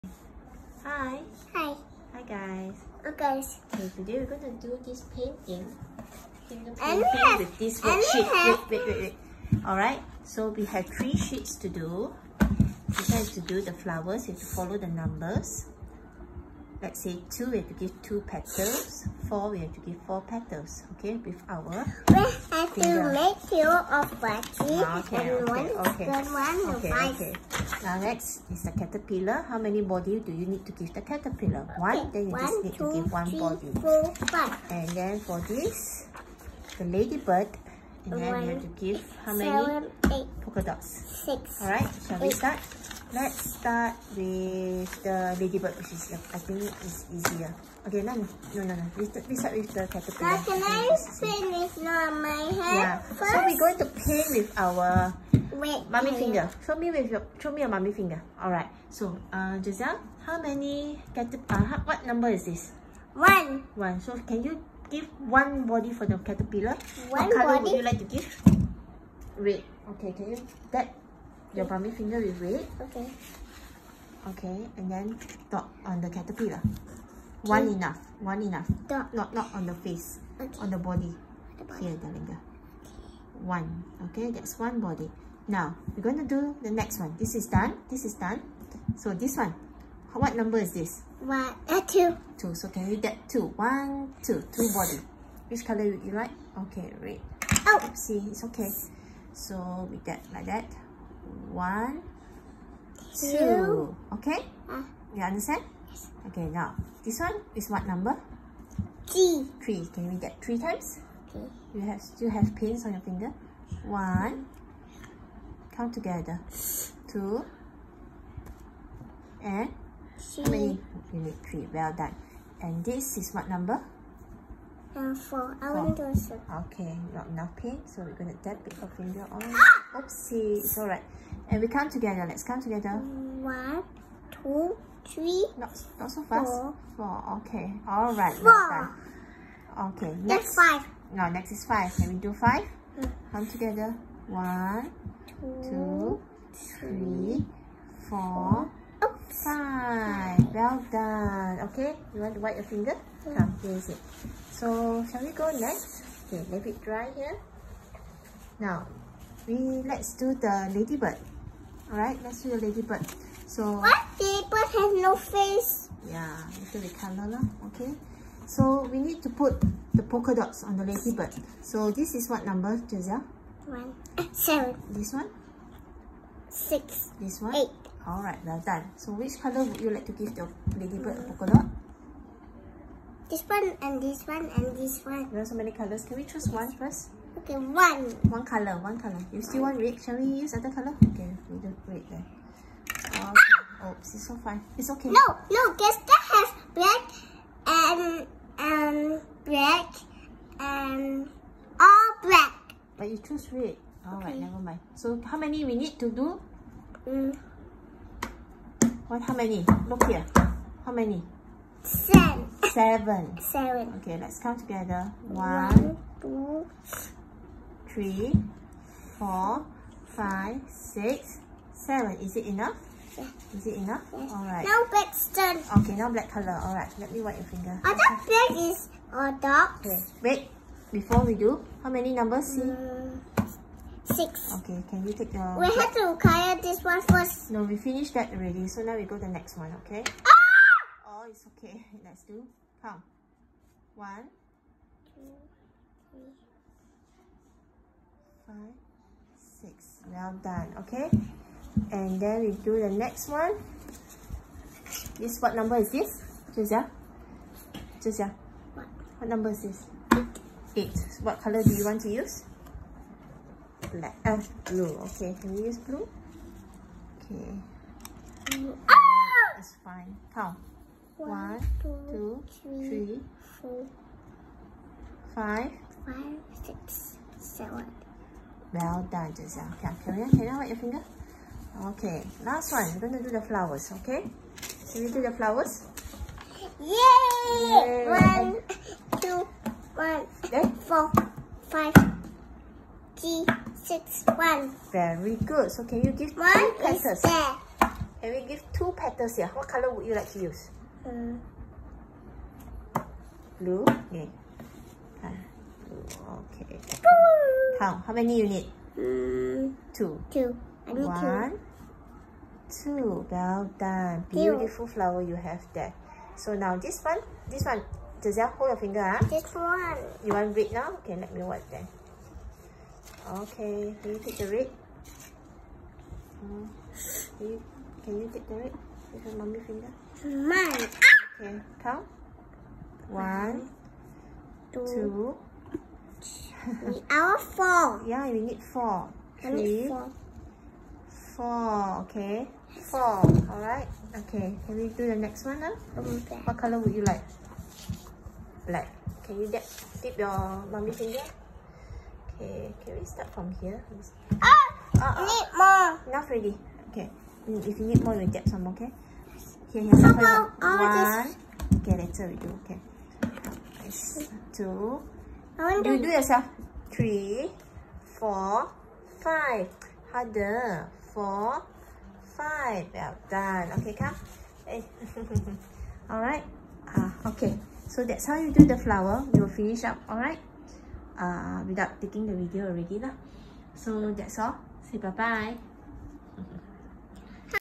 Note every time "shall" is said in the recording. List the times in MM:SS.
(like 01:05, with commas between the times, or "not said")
00:42, 02:35, 03:10.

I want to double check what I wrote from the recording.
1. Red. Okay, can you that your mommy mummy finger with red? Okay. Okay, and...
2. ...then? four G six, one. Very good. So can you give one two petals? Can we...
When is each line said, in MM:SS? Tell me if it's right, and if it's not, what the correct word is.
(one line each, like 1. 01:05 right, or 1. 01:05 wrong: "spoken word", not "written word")
1. 01:09 right
2. 04:50 right.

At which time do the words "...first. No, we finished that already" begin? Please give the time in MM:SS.
03:57.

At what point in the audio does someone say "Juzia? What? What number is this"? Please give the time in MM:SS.
04:18.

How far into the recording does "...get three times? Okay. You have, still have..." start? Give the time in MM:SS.
01:50.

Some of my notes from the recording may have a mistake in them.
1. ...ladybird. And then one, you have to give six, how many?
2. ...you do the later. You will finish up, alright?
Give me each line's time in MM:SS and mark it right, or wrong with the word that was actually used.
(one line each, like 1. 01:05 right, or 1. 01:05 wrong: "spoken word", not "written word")
1. 00:36 wrong: "eight", not "six"
2. 06:18 wrong: "flower", not "later".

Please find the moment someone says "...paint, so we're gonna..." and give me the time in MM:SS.
02:07.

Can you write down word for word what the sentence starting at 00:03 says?
Okay, today we're gonna do this painting.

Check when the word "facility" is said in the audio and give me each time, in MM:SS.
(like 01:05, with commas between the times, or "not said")
not said.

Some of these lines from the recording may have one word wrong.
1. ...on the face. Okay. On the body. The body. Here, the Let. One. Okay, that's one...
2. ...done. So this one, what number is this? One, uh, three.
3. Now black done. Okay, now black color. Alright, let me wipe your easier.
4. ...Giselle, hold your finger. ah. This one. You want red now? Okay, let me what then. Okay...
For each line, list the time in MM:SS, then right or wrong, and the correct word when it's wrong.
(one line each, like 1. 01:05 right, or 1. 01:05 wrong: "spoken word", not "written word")
1. 01:19 wrong: "Okay", not "Let"
2. 01:28 wrong: "two", not "three"
3. 03:44 wrong: "finger", not "easier"
4. 05:18 right.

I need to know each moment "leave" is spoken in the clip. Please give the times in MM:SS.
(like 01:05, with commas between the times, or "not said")
02:36.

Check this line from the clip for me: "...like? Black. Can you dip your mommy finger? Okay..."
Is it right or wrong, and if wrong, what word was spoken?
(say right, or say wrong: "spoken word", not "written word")
right.